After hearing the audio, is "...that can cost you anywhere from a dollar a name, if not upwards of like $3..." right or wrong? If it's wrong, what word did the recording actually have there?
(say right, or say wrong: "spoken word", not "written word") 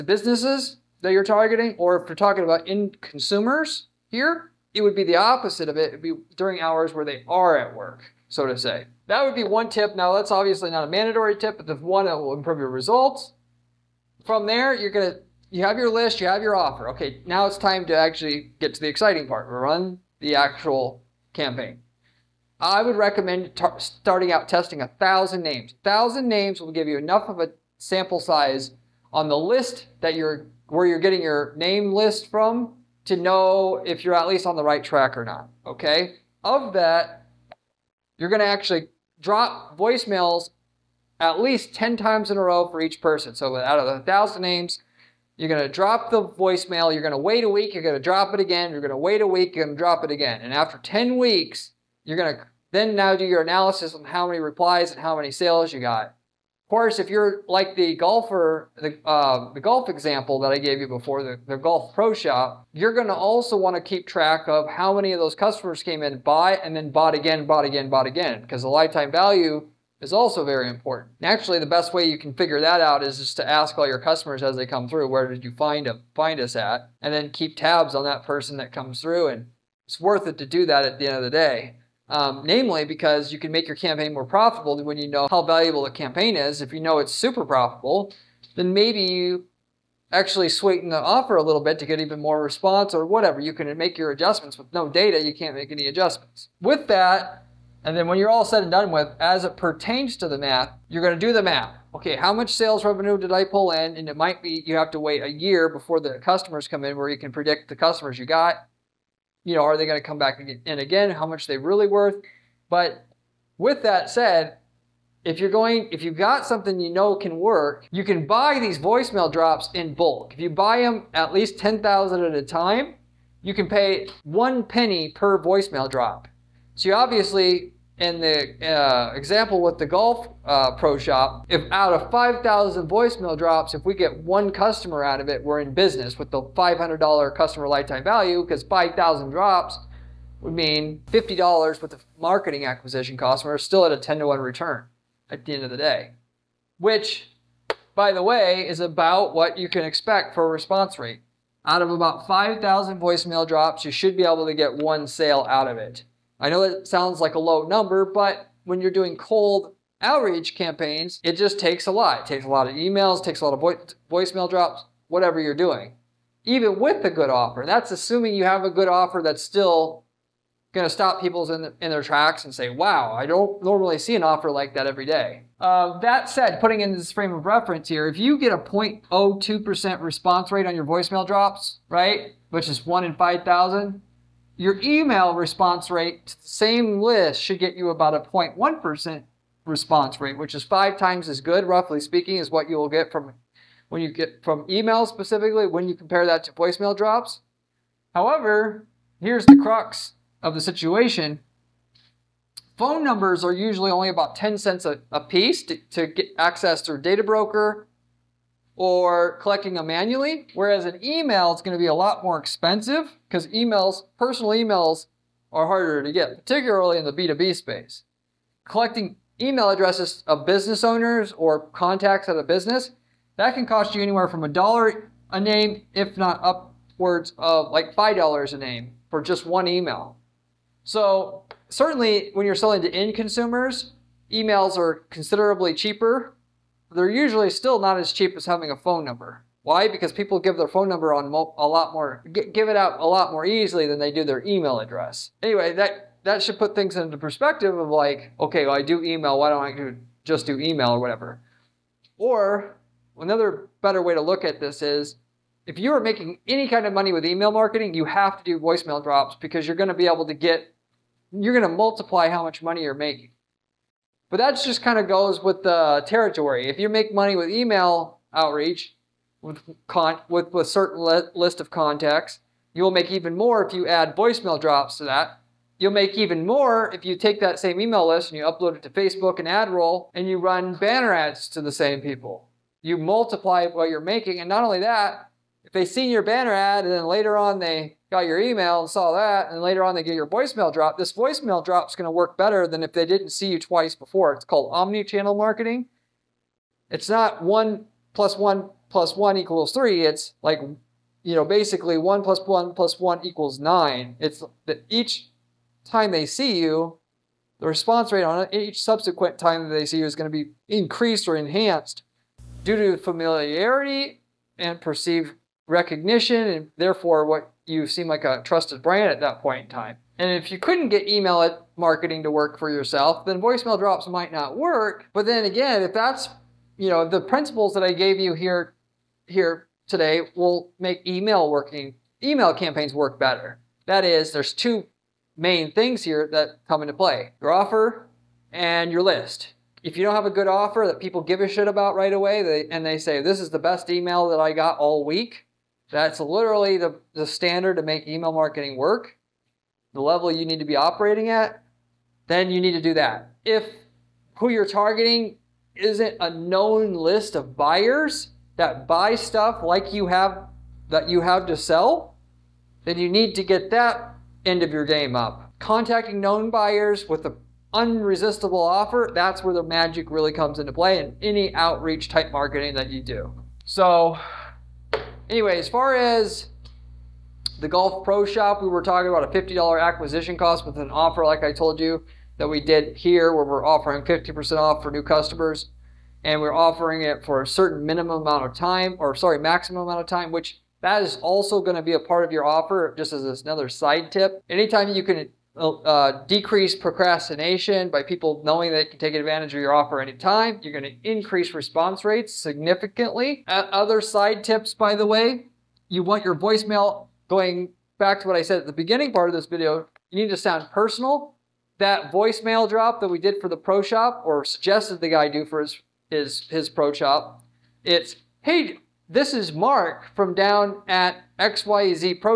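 wrong: "5", not "3".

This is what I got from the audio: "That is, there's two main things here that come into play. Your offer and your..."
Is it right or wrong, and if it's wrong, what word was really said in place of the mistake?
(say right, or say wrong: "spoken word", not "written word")
right.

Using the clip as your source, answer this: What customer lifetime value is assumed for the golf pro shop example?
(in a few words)
$500.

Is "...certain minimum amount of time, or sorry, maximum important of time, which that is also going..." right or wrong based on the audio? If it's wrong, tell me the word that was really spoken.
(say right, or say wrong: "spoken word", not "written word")
wrong: "amount", not "important".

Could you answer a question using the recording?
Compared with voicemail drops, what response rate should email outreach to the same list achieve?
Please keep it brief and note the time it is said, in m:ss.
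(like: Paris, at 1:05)
0.1%, at 3:08.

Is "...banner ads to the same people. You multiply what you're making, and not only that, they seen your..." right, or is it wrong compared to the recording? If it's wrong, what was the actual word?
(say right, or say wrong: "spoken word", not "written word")
right.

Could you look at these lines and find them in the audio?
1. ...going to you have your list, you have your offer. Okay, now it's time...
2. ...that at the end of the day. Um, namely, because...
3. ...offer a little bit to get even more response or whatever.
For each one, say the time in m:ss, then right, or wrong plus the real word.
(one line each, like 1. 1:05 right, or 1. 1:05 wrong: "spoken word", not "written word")
1. 0:14 right
2. 1:20 right
3. 1:30 right.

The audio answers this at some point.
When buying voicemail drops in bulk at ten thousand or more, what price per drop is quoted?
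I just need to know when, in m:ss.
2:04.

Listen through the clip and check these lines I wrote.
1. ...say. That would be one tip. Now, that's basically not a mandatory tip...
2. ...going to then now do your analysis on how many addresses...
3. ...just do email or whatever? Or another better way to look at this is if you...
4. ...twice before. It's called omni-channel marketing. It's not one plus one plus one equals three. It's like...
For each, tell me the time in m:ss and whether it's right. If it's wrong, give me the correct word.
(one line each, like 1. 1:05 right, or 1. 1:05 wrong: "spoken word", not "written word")
1. 0:08 wrong: "obviously", not "basically"
2. 0:52 wrong: "replies", not "addresses"
3. 4:10 right
4. 4:53 right.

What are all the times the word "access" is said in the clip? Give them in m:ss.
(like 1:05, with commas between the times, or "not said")
3:26.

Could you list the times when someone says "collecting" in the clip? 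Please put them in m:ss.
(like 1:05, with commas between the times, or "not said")
3:29, 3:38.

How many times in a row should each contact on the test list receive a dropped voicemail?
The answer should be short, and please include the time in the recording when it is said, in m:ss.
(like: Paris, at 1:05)
10 times, at 0:41.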